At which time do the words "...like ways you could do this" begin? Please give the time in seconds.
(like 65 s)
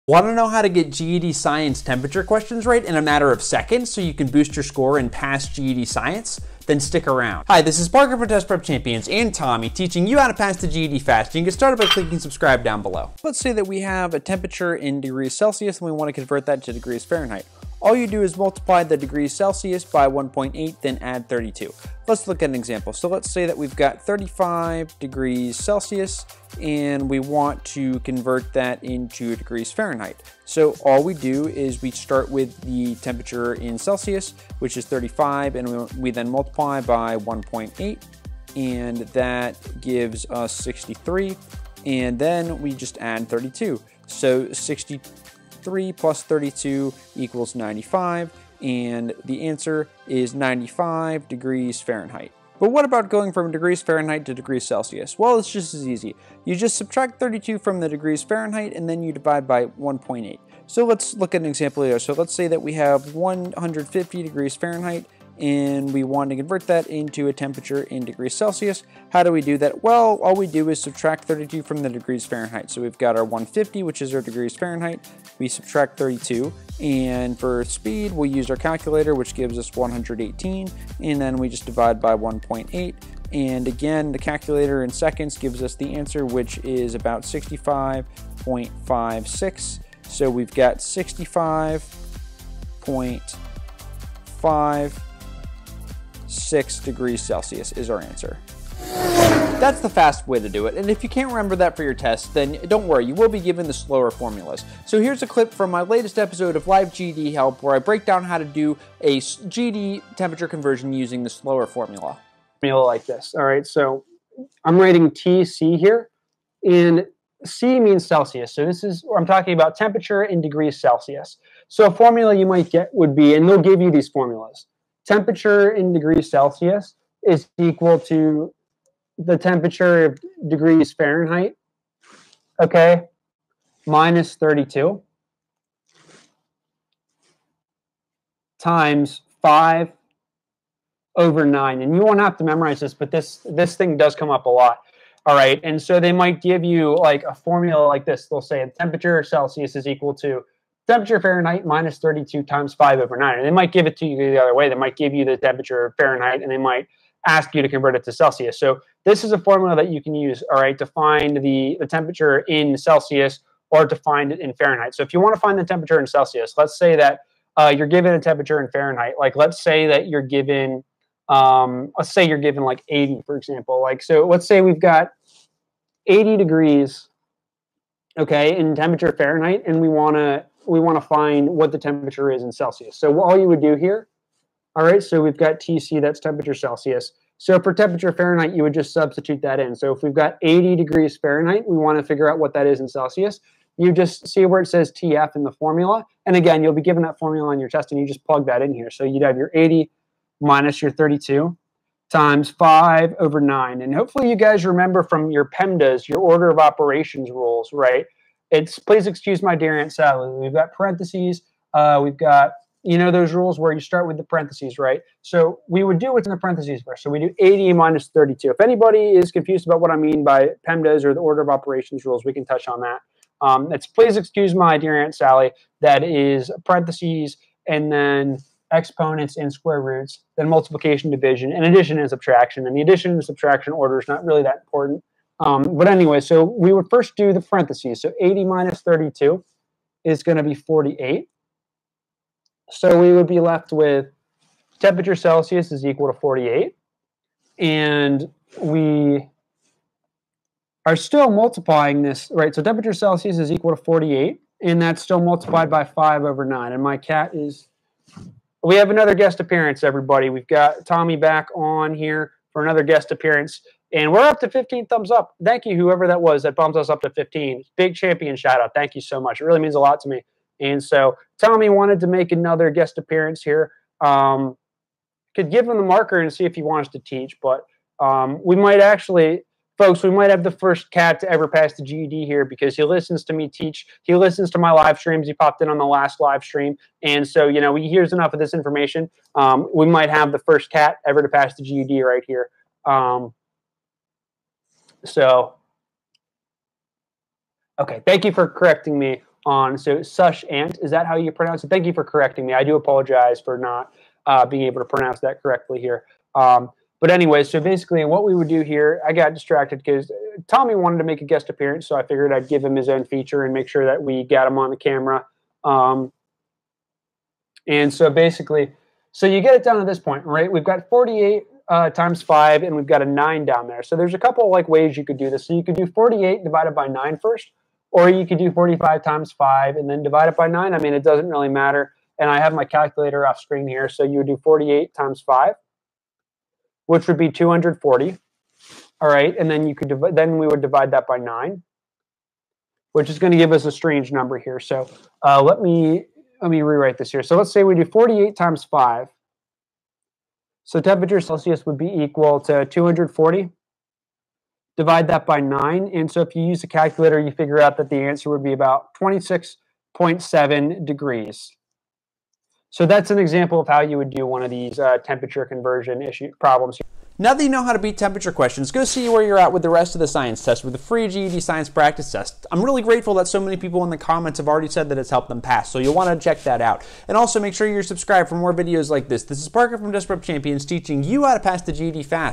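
324 s.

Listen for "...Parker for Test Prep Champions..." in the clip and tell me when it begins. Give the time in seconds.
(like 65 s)
7 s.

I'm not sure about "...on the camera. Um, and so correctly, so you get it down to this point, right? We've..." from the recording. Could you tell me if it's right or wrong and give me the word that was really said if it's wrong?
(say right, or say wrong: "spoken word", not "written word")
wrong: "basically", not "correctly".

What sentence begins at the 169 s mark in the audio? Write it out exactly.
Like let's say that you're given, um, let's say you're given like 80, for example.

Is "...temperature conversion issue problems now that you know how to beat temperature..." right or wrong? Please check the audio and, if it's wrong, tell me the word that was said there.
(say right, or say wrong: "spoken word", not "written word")
right.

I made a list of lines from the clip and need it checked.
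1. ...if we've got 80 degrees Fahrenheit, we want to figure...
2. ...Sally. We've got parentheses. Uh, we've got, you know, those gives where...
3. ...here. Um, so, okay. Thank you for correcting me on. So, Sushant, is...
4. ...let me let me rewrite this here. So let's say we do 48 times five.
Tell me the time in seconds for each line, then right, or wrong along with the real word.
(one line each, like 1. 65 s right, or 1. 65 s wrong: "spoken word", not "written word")
1. 189 s right
2. 209 s wrong: "rules", not "gives"
3. 292 s right
4. 345 s right.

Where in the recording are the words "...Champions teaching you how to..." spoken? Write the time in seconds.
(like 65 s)
380 s.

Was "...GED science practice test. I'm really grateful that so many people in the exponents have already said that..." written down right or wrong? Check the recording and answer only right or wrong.
wrong.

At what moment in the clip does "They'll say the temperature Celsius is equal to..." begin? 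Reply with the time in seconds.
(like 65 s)
148 s.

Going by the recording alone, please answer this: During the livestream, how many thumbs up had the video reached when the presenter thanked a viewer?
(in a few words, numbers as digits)
15.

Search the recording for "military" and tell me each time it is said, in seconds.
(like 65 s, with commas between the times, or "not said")
not said.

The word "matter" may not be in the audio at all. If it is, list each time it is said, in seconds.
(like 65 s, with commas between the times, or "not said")
3 s, 331 s.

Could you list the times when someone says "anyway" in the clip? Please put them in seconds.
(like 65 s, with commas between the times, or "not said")
235 s, 307 s.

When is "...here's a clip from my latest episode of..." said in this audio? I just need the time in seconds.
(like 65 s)
104 s.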